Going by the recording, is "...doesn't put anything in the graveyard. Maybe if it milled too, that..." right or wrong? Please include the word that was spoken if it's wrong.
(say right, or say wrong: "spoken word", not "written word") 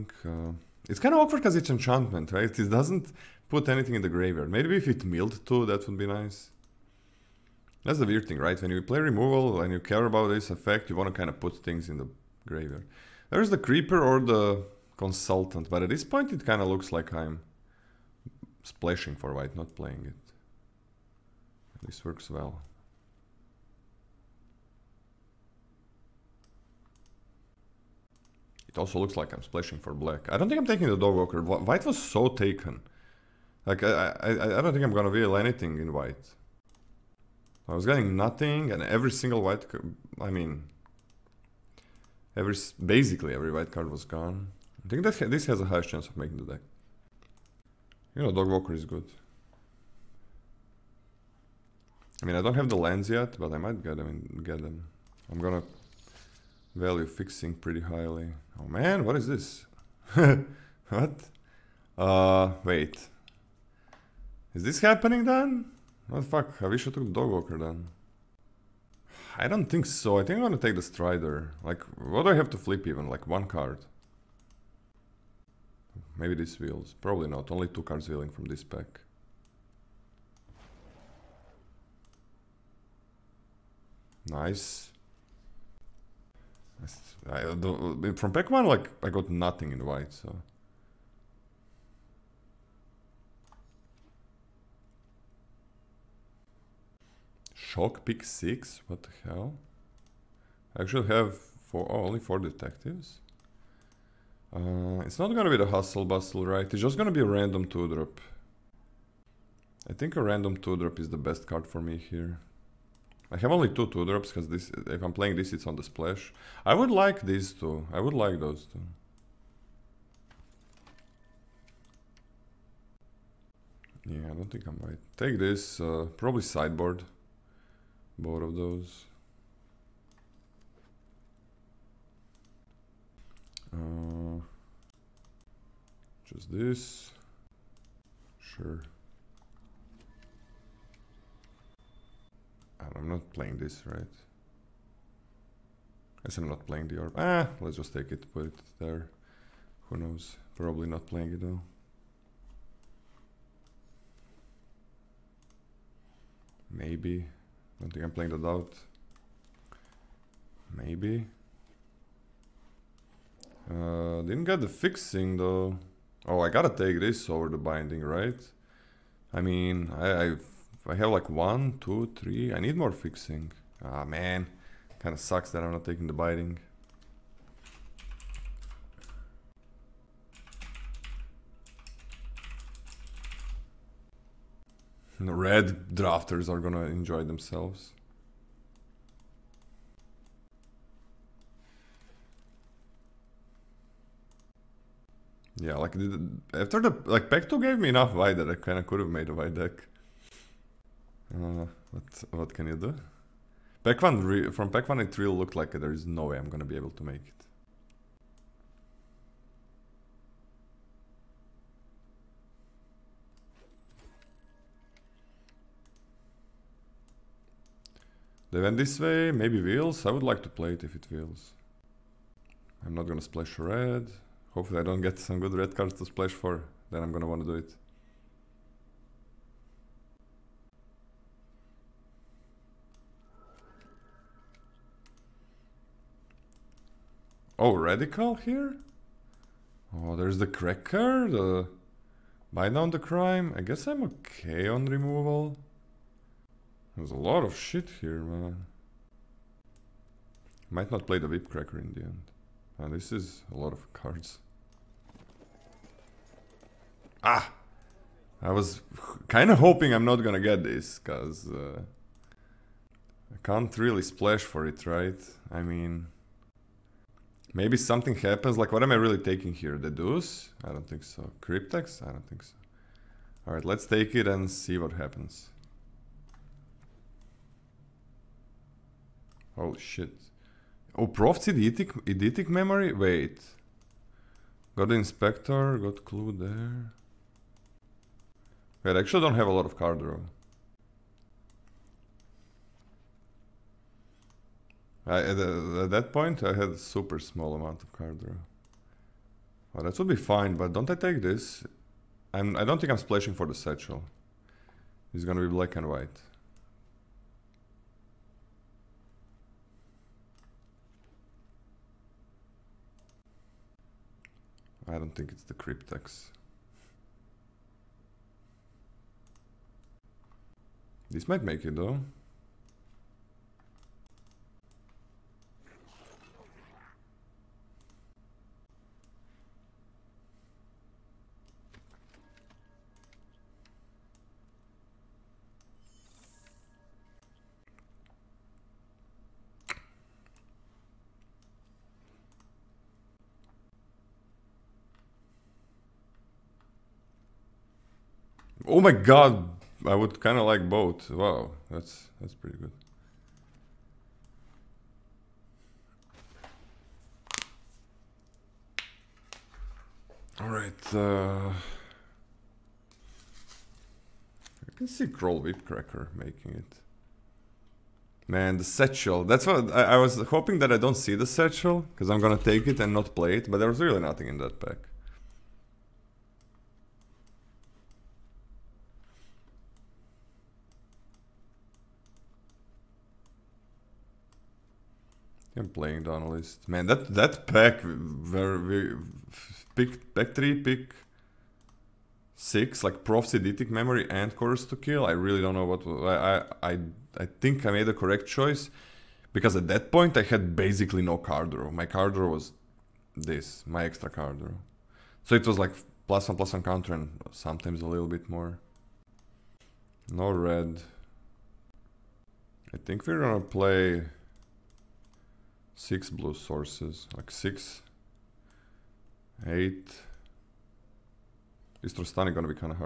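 right.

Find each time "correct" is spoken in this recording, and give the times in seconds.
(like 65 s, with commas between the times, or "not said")
397 s.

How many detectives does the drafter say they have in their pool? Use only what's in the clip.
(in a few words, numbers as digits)
4.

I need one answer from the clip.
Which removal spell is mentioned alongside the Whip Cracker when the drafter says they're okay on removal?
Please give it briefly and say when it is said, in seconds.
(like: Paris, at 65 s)
Bite Down on Crime, at 242 s.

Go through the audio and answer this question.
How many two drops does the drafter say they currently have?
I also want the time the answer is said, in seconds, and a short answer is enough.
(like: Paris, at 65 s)
2, at 113 s.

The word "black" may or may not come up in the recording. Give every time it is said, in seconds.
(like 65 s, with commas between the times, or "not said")
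29 s, 305 s.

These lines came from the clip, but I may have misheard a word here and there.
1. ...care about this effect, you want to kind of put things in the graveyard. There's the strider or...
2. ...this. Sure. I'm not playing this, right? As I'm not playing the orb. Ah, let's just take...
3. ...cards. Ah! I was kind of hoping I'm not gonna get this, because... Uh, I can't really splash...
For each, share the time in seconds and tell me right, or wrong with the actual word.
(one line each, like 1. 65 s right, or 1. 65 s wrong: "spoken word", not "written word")
1. 9 s wrong: "creeper", not "strider"
2. 136 s right
3. 253 s right.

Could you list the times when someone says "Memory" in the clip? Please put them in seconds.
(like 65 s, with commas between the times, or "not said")
282 s, 393 s.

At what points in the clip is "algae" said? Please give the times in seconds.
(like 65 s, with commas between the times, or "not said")
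not said.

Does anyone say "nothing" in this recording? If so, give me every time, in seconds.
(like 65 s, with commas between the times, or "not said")
38 s, 89 s, 374 s.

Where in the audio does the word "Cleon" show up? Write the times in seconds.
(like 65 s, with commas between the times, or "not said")
not said.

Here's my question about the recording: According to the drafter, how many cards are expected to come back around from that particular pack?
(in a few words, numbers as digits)
2.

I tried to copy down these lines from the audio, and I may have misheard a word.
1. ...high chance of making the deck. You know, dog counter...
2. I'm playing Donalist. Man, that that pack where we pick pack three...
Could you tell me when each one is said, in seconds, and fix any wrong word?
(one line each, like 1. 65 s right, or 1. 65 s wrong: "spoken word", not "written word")
1. 45 s wrong: "walker", not "counter"
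2. 385 s right.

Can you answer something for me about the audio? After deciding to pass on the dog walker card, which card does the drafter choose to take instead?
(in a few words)
the strider.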